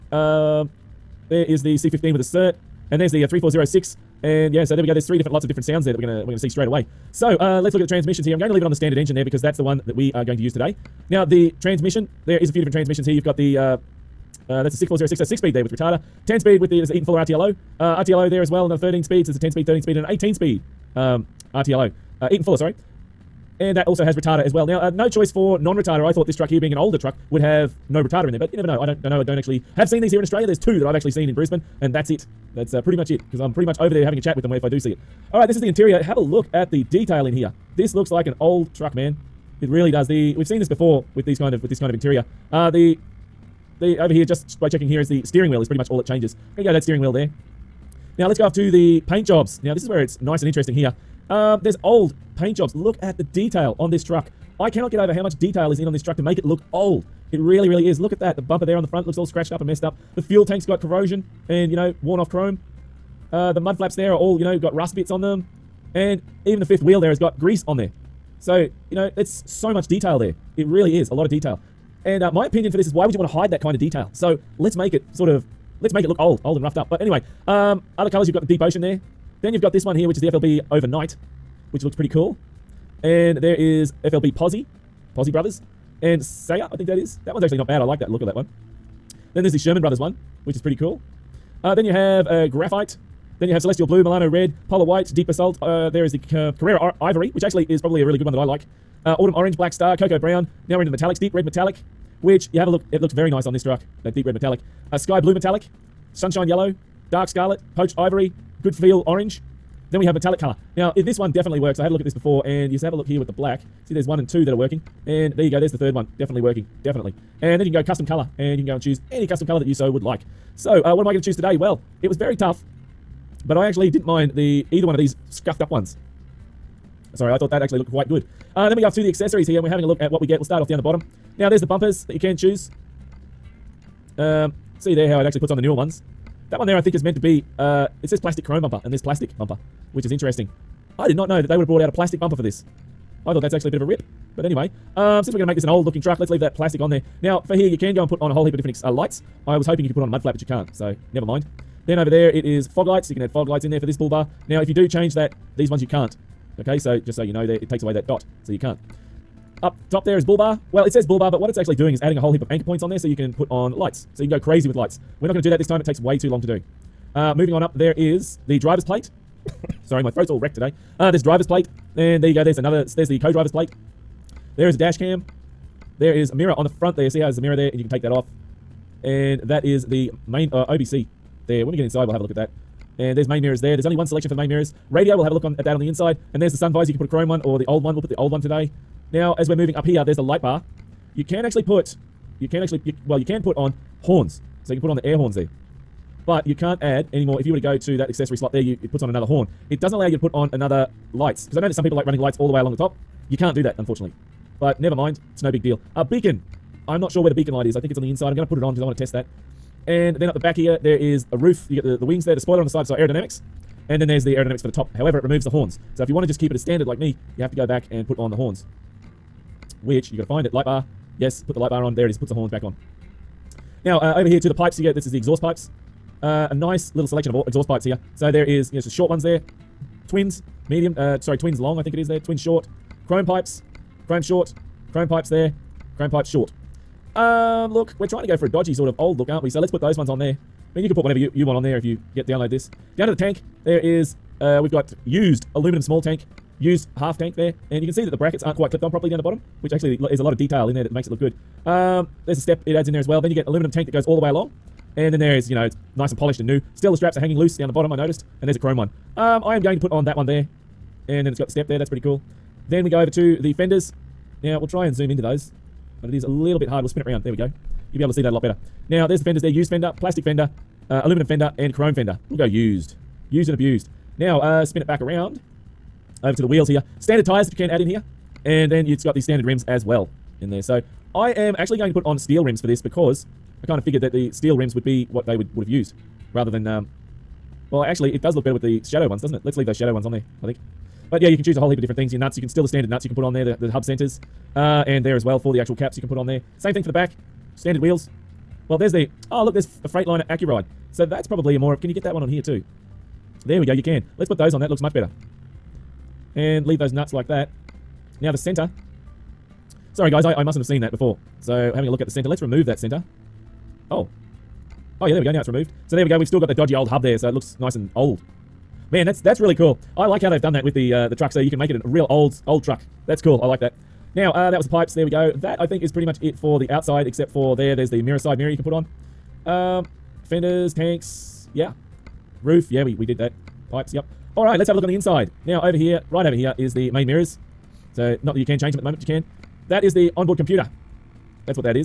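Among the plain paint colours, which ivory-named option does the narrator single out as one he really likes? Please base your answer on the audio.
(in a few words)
Carrera Ivory.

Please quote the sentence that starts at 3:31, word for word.
You get the, the wings there, the spoiler on the side, so aerodynamics.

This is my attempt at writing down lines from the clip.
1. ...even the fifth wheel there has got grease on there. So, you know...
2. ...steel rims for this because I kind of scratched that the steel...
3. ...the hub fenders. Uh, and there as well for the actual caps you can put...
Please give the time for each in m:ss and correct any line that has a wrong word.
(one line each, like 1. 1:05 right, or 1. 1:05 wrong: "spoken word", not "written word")
1. 1:06 right
2. 4:42 wrong: "figured", not "scratched"
3. 4:53 wrong: "centers", not "fenders".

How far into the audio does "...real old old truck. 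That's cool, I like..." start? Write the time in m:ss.
5:21.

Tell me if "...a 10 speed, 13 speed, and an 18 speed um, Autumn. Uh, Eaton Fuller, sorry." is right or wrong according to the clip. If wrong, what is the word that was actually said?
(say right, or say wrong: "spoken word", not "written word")
wrong: "RTLO", not "Autumn".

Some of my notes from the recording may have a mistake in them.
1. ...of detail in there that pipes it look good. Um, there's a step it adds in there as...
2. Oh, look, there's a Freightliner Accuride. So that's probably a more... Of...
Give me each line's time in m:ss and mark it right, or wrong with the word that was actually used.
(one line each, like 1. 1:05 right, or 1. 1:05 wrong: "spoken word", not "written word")
1. 4:10 wrong: "makes", not "pipes"
2. 4:59 right.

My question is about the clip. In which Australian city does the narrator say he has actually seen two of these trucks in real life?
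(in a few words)
Brisbane.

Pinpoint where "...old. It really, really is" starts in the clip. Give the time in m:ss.
0:56.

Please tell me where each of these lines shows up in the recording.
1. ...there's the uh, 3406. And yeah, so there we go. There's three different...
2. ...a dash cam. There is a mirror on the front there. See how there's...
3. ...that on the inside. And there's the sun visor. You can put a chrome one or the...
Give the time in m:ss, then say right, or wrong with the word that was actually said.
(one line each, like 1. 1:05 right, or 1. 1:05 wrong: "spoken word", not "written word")
1. 0:02 right
2. 2:54 right
3. 3:05 right.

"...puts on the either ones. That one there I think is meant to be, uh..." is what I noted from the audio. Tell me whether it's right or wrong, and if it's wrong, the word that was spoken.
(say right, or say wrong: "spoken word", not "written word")
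wrong: "newer", not "either".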